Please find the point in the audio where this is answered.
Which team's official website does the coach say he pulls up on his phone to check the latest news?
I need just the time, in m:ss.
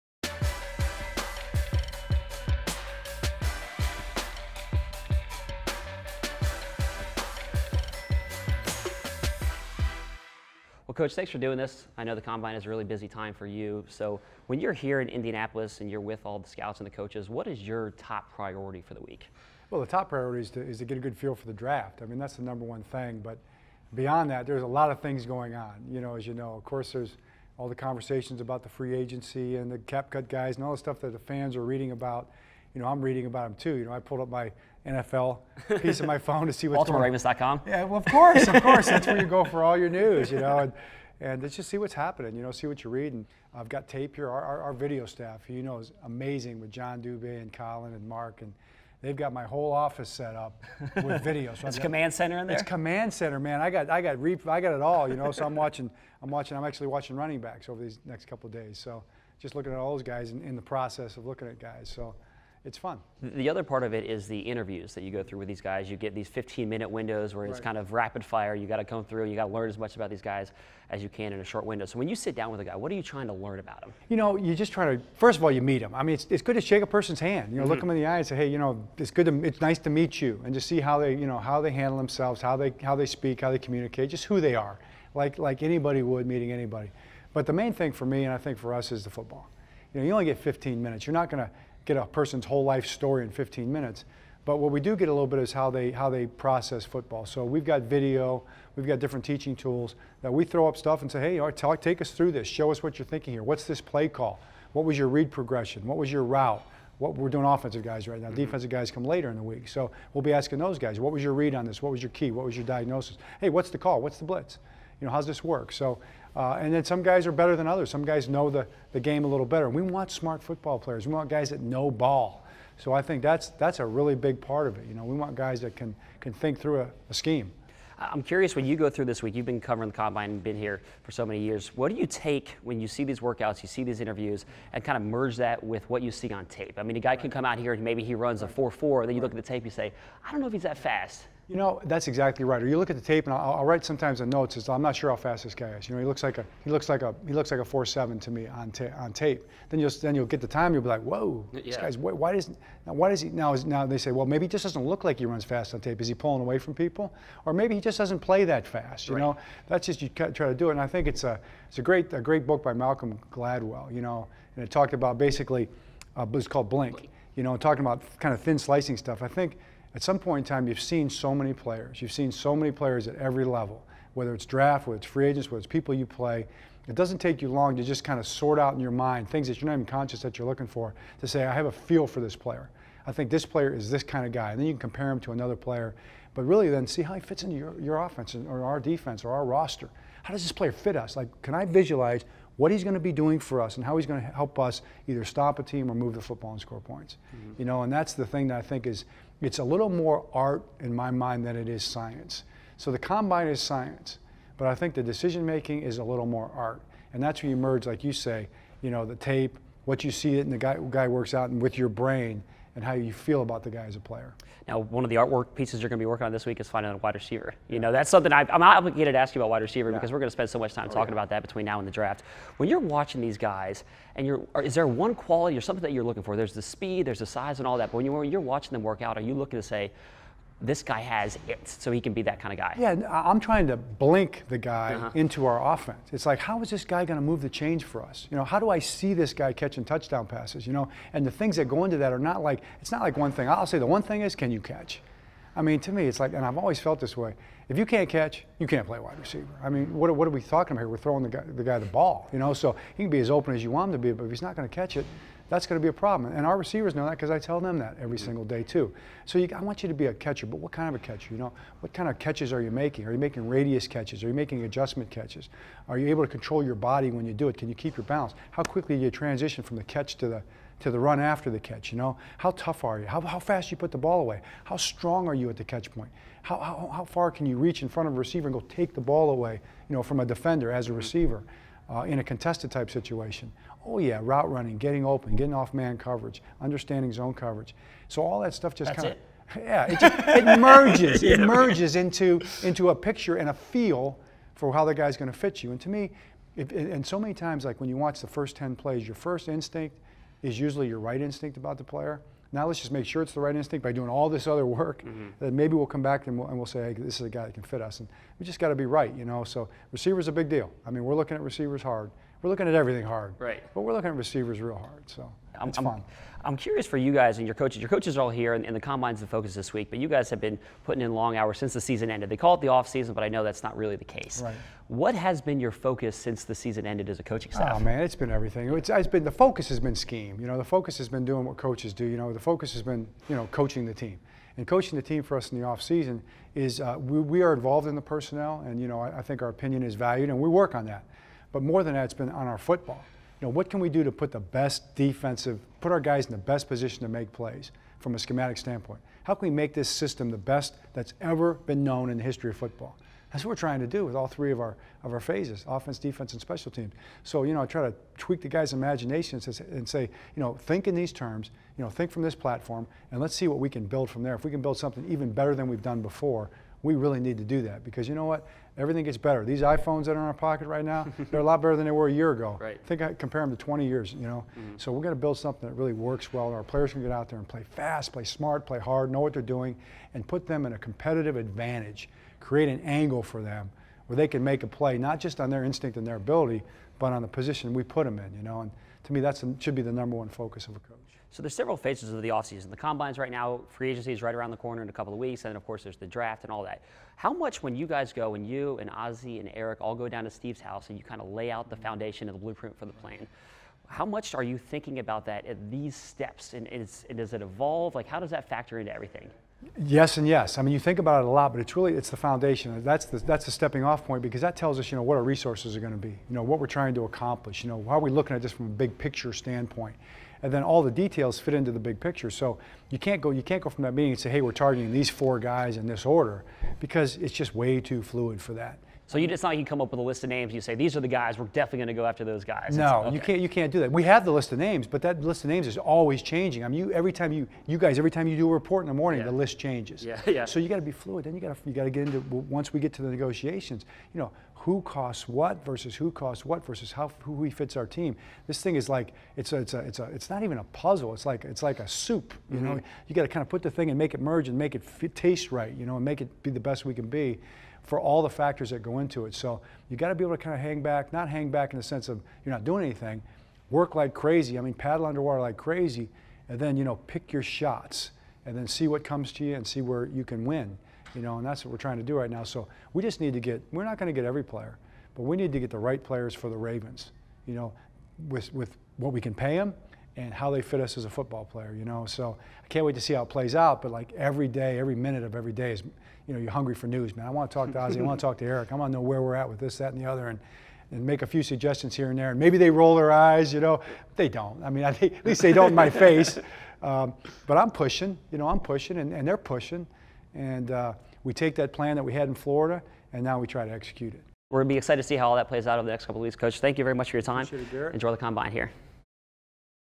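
0:36.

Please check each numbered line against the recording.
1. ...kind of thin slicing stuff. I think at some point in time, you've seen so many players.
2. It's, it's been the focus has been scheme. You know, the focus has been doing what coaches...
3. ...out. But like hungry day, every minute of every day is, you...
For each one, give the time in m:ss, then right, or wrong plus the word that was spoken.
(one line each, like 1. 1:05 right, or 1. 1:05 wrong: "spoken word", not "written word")
1. 2:48 right
2. 5:28 right
3. 8:03 wrong: "every", not "hungry".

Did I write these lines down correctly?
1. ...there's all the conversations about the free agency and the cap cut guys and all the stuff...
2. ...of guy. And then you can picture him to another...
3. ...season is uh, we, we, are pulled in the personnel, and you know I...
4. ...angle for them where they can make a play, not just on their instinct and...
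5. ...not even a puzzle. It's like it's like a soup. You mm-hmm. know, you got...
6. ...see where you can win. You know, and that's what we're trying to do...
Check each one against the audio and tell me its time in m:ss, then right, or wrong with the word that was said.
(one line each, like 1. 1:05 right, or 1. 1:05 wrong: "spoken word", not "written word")
1. 0:26 right
2. 3:04 wrong: "compare", not "picture"
3. 5:35 wrong: "involved", not "pulled"
4. 6:22 right
5. 7:30 right
6. 7:49 right.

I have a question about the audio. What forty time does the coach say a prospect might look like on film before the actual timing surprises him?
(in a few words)
4.7.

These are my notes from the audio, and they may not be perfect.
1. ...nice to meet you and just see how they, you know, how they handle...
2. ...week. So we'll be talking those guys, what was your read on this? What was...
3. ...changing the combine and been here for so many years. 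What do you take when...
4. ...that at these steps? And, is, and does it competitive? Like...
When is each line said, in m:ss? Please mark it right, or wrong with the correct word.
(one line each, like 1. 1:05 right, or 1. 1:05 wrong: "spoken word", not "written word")
1. 1:19 right
2. 1:49 wrong: "asking", not "talking"
3. 2:09 wrong: "covering", not "changing"
4. 6:45 wrong: "evolve", not "competitive".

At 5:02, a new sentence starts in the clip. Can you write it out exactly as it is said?
Now let's just make sure it's the right instinct by doing all this other work.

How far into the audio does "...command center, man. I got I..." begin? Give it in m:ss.
0:52.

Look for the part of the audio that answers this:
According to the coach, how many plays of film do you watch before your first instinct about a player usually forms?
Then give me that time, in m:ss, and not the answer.
4:58.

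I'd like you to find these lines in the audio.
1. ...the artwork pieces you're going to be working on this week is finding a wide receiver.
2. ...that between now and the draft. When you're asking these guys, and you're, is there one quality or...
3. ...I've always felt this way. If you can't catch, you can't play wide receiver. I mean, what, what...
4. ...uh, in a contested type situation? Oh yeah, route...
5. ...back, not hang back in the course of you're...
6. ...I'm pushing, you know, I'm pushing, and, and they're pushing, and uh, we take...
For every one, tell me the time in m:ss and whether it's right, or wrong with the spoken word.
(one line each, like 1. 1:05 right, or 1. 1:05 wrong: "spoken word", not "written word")
1. 3:35 right
2. 3:41 wrong: "watching", not "asking"
3. 4:06 right
4. 4:41 right
5. 7:40 wrong: "sense", not "course"
6. 8:17 right.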